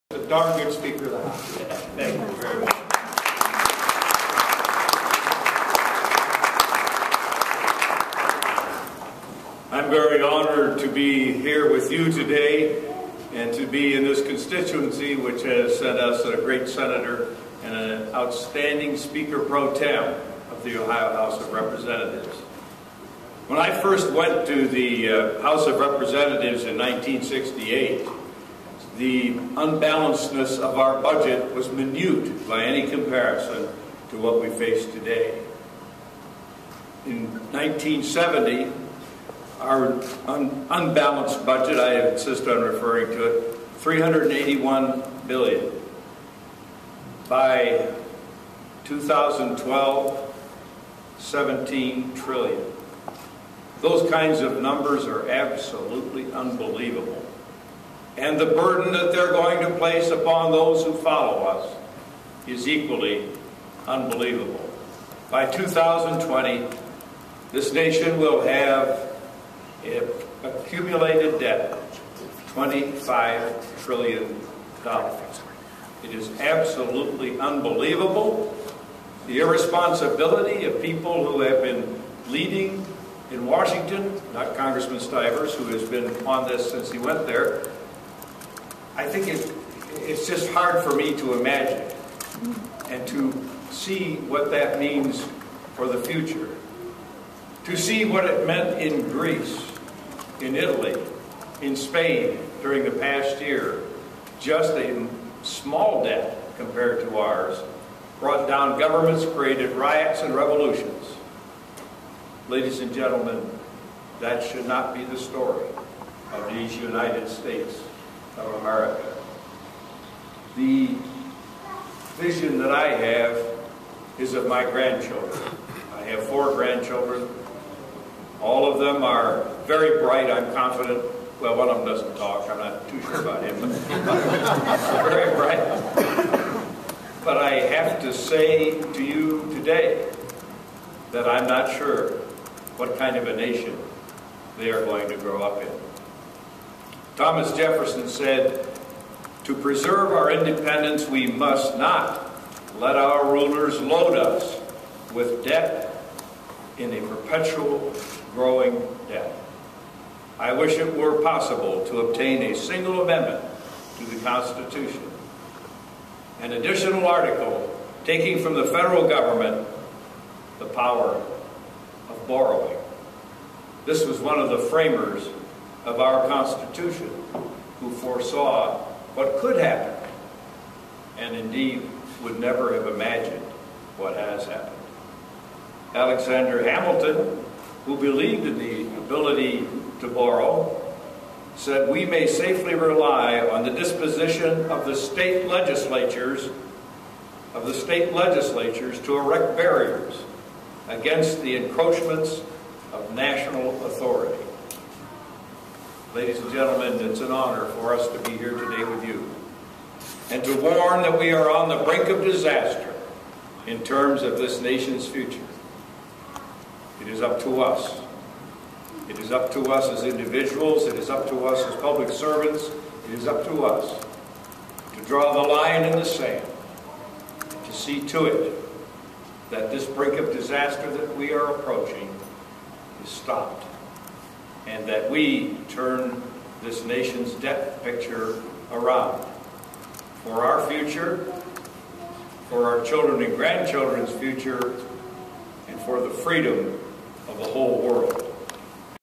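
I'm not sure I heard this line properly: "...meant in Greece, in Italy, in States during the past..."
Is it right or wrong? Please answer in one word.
wrong.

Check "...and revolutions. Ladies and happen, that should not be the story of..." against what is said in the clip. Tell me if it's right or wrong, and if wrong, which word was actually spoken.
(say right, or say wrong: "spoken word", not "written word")
wrong: "gentlemen", not "happen".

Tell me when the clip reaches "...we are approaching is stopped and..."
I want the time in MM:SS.
03:51.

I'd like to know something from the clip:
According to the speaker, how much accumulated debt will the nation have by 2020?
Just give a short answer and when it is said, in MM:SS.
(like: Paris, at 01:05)
$25 trillion, at 01:12.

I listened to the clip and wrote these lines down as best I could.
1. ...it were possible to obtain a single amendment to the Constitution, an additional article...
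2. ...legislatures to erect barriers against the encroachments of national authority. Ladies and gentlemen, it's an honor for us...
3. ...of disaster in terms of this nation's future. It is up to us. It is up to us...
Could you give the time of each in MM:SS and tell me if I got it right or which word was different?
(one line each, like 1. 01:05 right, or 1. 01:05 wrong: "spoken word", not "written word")
1. 02:40 right
2. 03:18 right
3. 03:32 right.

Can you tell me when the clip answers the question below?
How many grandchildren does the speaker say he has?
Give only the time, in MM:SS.
02:06.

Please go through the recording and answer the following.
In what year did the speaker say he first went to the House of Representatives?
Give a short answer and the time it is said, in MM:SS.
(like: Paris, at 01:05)
1968, at 00:26.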